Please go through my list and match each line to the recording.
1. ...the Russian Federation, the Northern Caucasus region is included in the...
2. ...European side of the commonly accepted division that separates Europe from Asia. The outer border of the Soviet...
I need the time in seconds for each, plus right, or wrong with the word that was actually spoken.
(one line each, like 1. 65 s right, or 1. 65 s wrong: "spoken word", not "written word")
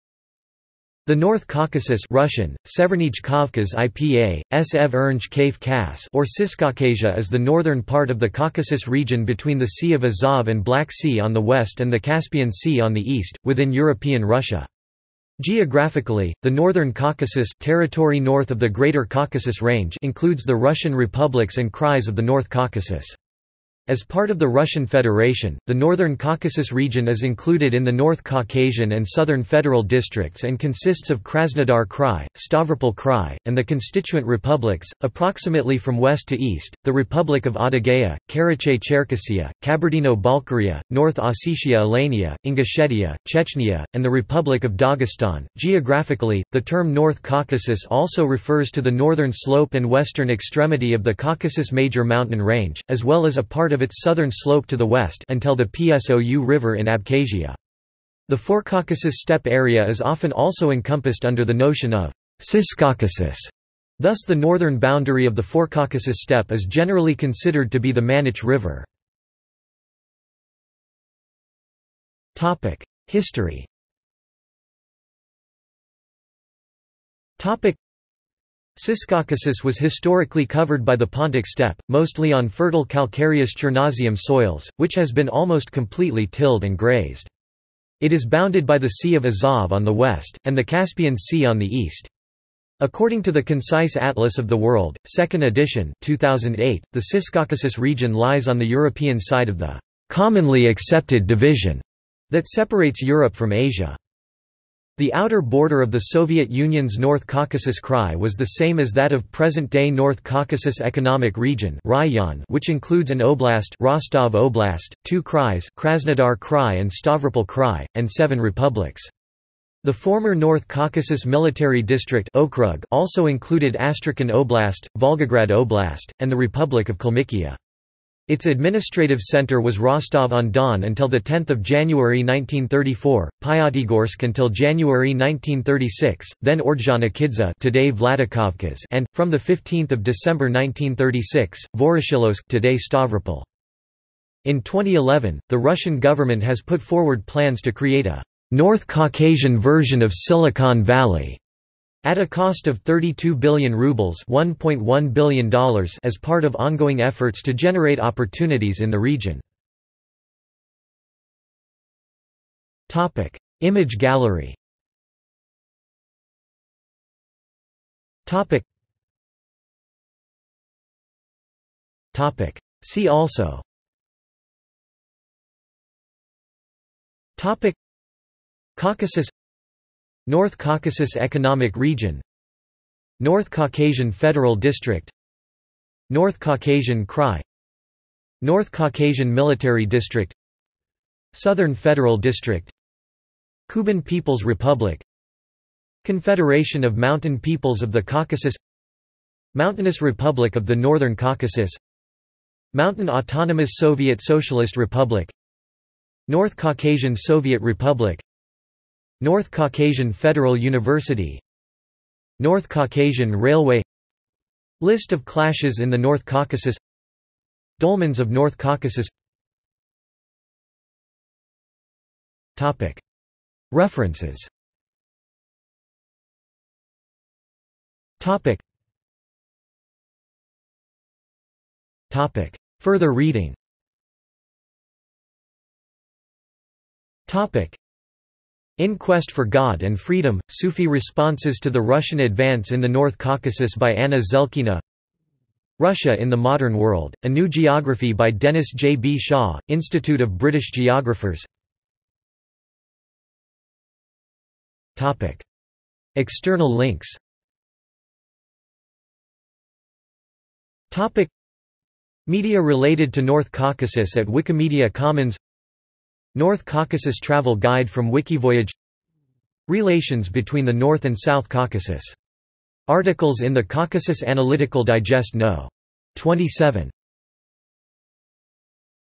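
1. 24 s right
2. 98 s right.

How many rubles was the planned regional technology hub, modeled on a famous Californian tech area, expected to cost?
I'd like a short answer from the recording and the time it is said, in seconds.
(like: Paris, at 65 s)
32 billion rubles, at 152 s.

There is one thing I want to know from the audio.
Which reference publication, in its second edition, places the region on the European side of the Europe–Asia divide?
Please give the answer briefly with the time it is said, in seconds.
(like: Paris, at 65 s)
Concise Atlas of the World, at 93 s.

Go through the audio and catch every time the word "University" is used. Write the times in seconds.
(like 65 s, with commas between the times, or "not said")
210 s.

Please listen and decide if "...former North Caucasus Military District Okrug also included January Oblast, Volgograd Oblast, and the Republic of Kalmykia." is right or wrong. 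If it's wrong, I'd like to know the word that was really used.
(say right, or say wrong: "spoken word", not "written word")
wrong: "Astrakhan", not "January".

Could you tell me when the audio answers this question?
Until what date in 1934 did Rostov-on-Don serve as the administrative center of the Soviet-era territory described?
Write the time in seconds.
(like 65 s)
131 s.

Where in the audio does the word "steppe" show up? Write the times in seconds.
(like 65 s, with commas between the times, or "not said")
59 s, 66 s, 81 s.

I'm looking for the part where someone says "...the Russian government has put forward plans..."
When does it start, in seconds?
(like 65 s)
145 s.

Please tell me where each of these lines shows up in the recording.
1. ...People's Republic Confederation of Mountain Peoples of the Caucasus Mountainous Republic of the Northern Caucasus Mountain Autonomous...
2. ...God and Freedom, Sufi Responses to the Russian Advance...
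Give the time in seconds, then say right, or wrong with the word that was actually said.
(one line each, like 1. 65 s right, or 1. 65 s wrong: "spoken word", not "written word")
1. 194 s right
2. 239 s right.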